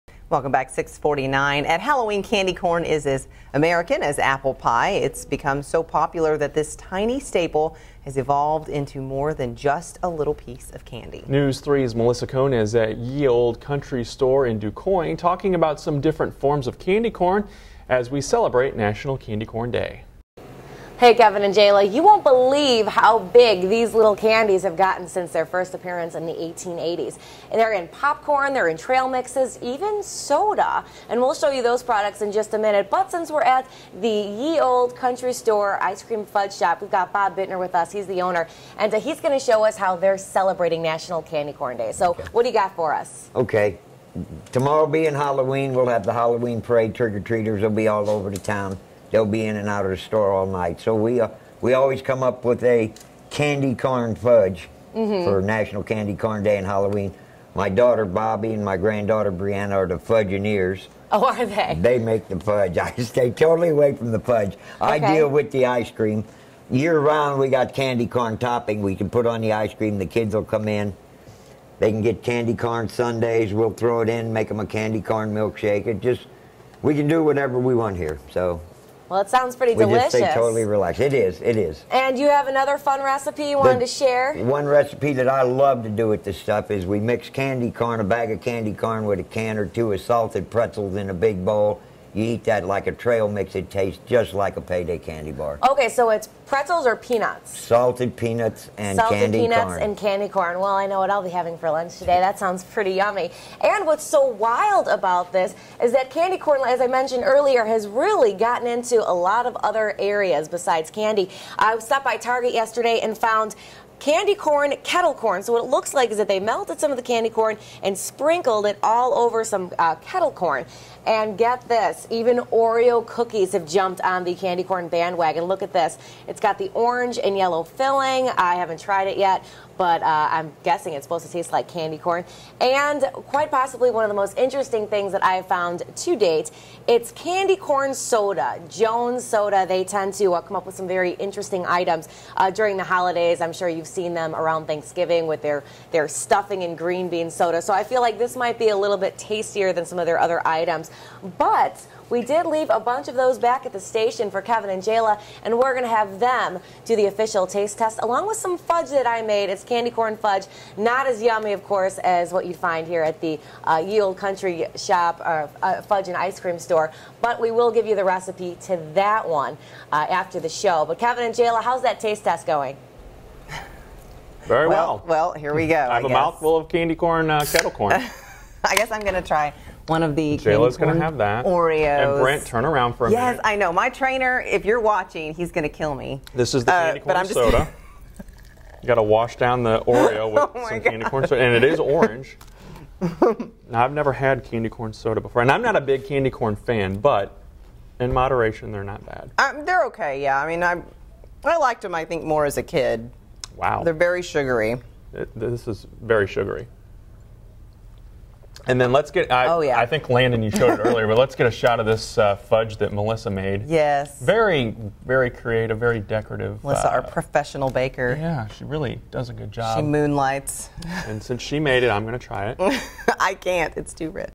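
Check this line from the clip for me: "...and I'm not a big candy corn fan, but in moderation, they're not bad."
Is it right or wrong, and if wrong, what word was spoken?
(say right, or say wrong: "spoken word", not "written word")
right.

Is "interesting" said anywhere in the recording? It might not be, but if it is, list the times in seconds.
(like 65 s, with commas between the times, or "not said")
134 s, 141 s.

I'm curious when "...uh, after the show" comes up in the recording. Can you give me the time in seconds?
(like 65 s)
169 s.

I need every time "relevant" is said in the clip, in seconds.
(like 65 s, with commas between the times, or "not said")
not said.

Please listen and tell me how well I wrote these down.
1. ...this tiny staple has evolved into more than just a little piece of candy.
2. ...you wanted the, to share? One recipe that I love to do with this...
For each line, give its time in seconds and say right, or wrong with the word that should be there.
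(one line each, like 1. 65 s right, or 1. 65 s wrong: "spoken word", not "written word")
1. 6 s right
2. 83 s right.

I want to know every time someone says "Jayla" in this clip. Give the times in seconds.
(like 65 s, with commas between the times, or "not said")
21 s, 154 s, 171 s, 180 s.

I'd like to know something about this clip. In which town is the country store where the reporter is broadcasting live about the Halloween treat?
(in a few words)
Du Quoin.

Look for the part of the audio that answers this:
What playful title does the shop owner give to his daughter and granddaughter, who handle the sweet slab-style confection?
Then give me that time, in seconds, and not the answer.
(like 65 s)
60 s.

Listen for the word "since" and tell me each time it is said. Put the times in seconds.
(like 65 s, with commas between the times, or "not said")
25 s, 33 s, 221 s.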